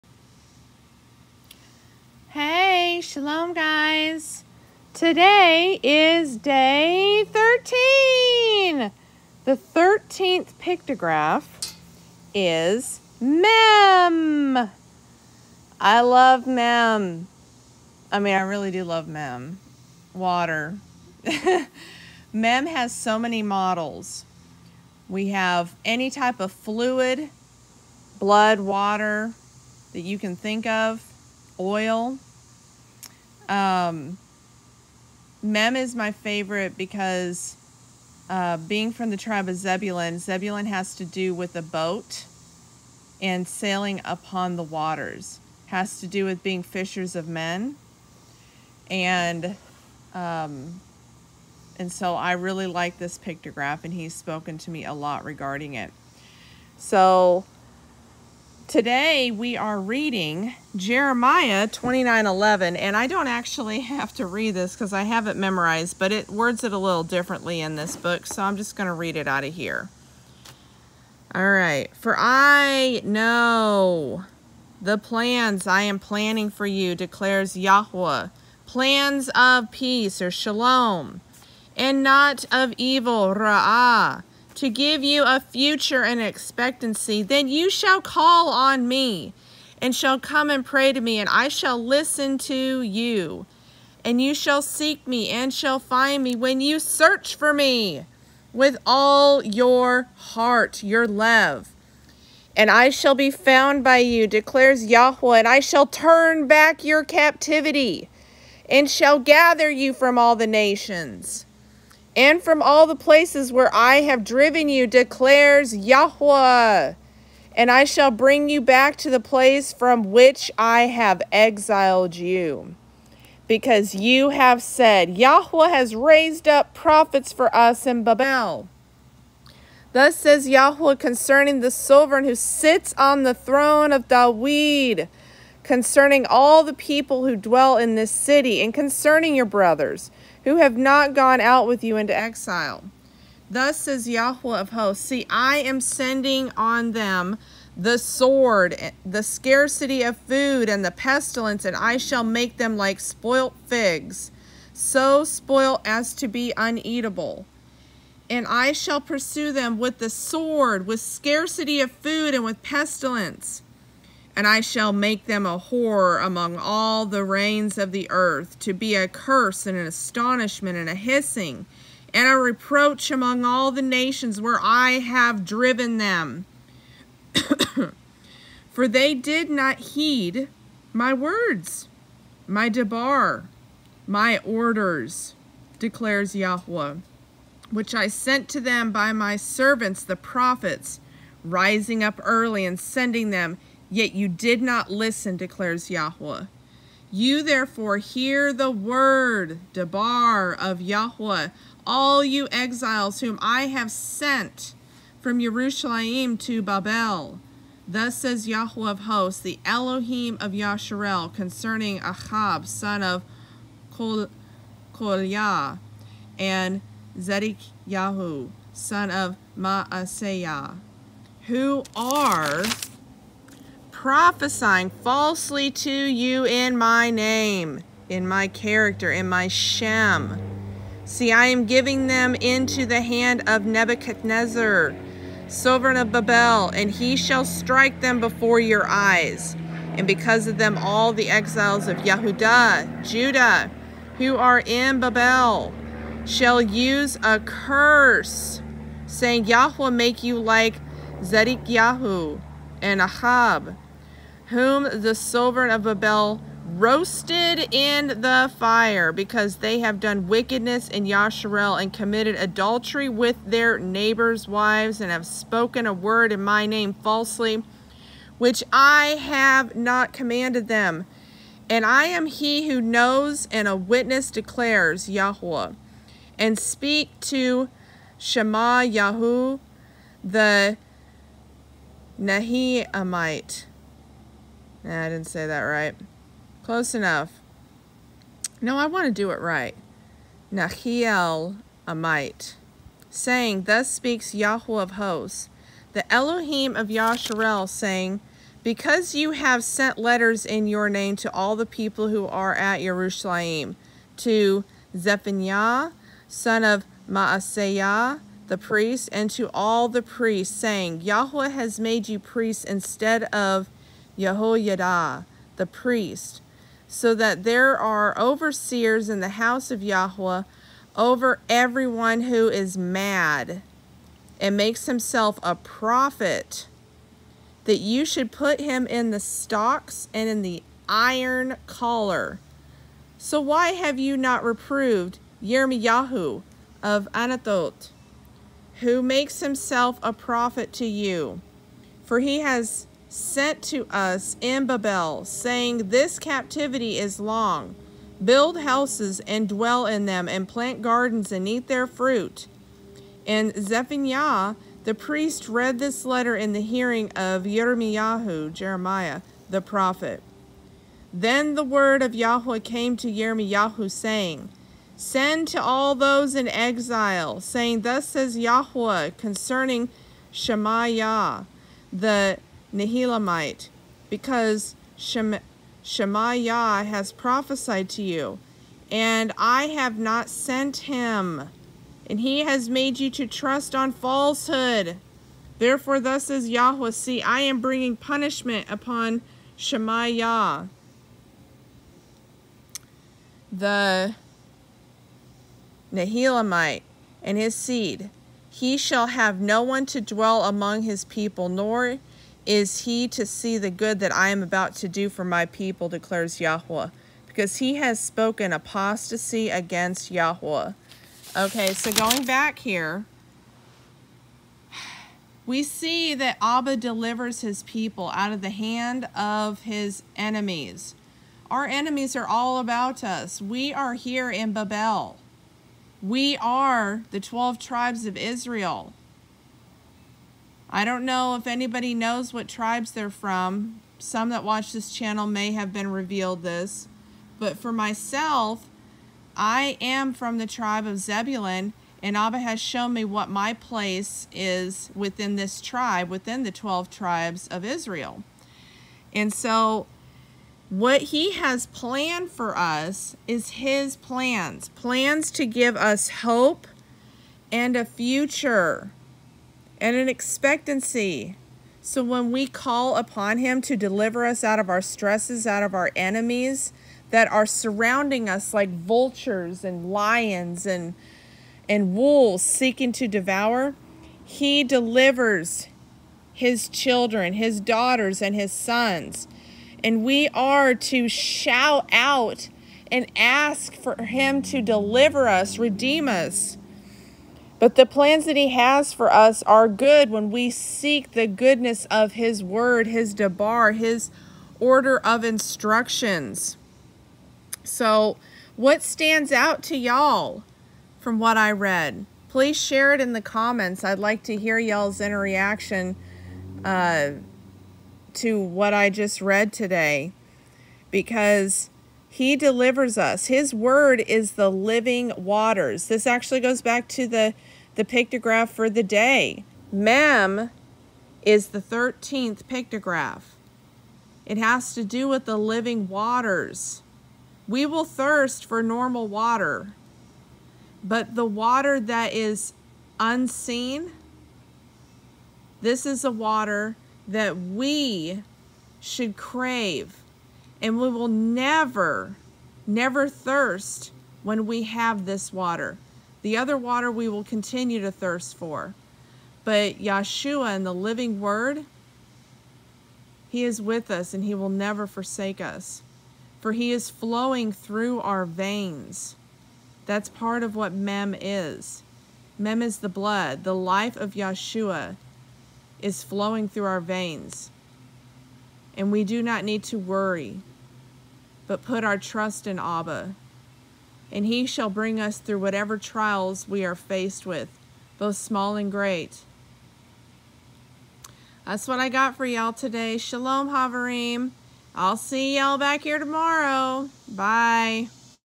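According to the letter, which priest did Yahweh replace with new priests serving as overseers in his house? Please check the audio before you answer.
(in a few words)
Yehoiada.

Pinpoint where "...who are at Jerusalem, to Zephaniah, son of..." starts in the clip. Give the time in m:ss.
5:02.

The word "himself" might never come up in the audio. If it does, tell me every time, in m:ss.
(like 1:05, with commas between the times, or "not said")
5:24, 5:39.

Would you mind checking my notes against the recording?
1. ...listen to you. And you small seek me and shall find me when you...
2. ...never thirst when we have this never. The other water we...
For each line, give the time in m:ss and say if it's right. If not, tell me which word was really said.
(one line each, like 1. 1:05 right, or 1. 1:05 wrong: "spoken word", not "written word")
1. 1:31 wrong: "shall", not "small"
2. 9:02 wrong: "water", not "never".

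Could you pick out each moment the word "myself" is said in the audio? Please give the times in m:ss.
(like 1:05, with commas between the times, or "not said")
7:17.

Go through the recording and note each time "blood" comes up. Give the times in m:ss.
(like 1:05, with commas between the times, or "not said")
0:28, 9:22.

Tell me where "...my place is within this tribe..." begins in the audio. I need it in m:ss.
7:23.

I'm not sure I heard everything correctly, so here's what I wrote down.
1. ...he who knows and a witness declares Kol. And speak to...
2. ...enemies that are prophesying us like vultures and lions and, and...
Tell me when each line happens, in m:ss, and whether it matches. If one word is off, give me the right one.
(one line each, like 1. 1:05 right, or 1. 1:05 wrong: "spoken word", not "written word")
1. 4:32 wrong: "Yahweh", not "Kol"
2. 7:45 wrong: "surrounding", not "prophesying".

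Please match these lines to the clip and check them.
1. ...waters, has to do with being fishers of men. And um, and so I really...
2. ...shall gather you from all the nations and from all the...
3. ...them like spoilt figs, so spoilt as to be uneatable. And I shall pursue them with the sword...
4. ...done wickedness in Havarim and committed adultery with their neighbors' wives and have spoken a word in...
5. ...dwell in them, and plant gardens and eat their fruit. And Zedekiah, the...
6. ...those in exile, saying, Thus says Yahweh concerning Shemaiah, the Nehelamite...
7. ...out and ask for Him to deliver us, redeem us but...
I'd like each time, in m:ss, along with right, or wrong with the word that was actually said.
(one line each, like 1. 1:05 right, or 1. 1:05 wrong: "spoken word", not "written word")
1. 0:44 right
2. 1:48 right
3. 2:32 right
4. 4:20 wrong: "Yasharel", not "Havarim"
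5. 5:49 wrong: "Zephaniah", not "Zedekiah"
6. 6:05 right
7. 8:01 right.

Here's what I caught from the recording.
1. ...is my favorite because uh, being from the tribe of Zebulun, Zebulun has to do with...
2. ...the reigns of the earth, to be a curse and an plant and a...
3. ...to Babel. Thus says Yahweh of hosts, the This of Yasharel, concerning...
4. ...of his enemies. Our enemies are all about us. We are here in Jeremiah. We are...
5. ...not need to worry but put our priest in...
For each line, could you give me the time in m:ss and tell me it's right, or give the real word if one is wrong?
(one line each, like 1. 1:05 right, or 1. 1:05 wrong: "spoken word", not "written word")
1. 0:35 right
2. 2:47 wrong: "astonishment", not "plant"
3. 3:26 wrong: "Elohim", not "This"
4. 6:59 wrong: "Babel", not "Jeremiah"
5. 9:29 wrong: "trust", not "priest".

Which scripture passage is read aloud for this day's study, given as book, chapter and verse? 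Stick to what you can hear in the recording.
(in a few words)
Jeremiah 29:11.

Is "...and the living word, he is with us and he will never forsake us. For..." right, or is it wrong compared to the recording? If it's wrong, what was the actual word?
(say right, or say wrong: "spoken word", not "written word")
right.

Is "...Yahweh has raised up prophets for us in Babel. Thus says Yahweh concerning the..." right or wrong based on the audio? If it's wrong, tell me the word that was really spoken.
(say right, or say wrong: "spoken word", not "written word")
right.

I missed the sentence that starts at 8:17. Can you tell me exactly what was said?
So what stands out to y'all from what I read?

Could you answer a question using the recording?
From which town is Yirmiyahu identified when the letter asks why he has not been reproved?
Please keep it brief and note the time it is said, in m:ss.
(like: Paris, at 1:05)
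Anatot, at 5:37.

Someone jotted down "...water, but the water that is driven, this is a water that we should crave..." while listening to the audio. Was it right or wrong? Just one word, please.
wrong.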